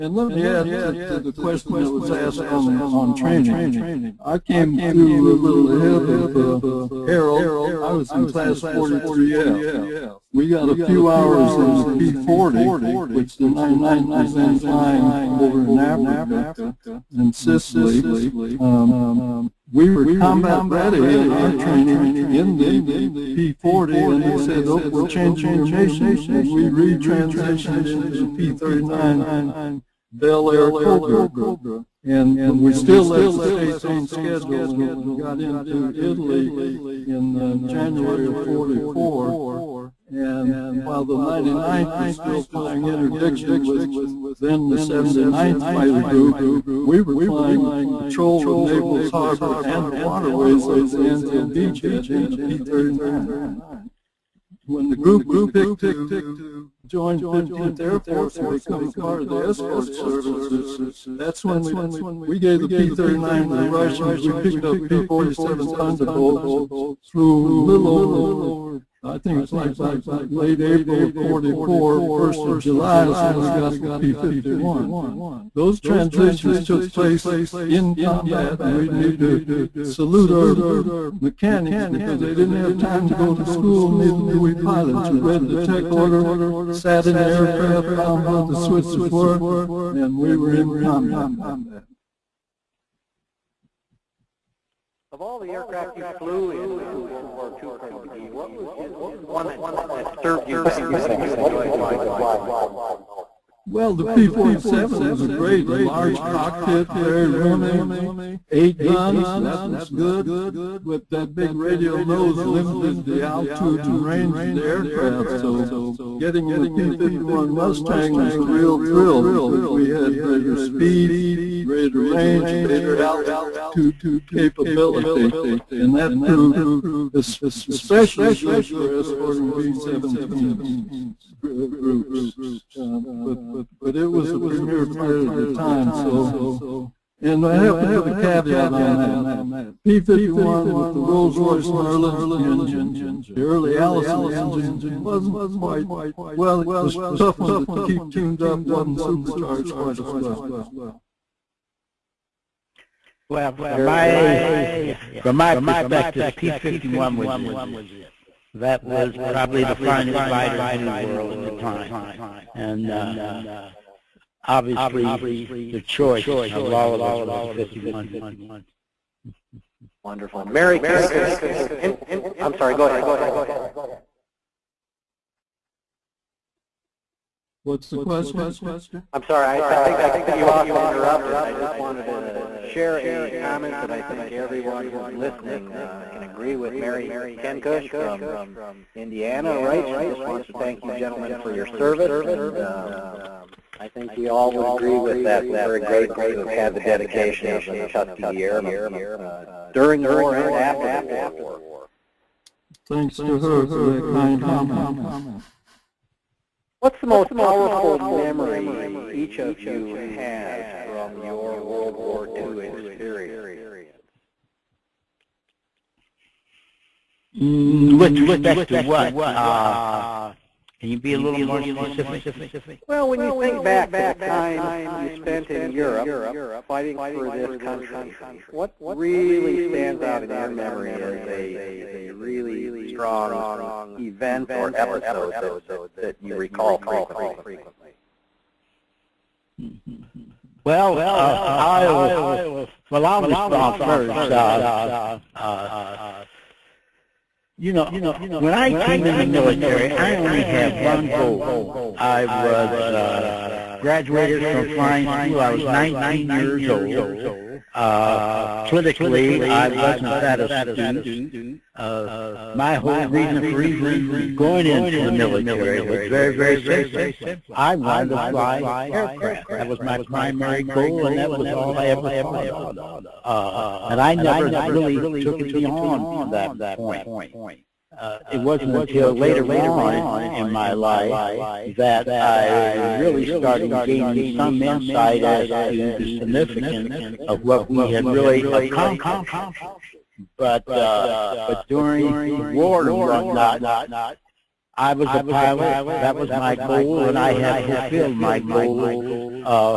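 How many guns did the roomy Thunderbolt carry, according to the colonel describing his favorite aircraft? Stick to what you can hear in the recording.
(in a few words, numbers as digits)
8.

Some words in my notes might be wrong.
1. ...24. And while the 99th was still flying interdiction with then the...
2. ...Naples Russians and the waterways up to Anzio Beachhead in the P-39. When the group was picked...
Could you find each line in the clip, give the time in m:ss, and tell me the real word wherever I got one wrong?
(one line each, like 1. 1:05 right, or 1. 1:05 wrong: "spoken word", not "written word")
1. 0:38 wrong: "44", not "24"
2. 0:48 wrong: "Harbor", not "Russians".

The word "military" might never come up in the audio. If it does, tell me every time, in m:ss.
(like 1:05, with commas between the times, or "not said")
4:09, 4:25.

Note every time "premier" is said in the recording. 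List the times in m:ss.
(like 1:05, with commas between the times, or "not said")
2:14.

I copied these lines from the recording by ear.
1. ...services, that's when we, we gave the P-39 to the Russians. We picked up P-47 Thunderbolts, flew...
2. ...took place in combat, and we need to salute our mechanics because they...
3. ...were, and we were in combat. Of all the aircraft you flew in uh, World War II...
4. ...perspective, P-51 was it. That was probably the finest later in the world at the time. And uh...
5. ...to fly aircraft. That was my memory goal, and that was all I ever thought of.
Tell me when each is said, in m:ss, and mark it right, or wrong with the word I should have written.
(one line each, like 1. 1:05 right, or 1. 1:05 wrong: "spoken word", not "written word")
1. 0:59 right
2. 1:16 right
3. 1:29 right
4. 2:35 wrong: "fighter", not "later"
5. 4:28 wrong: "primary", not "memory".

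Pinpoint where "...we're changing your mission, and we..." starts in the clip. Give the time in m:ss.
0:24.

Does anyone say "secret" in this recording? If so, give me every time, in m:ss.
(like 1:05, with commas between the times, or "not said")
not said.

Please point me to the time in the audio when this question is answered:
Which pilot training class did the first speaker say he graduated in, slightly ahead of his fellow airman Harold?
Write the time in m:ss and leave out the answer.
0:08.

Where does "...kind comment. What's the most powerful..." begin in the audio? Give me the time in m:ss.
3:24.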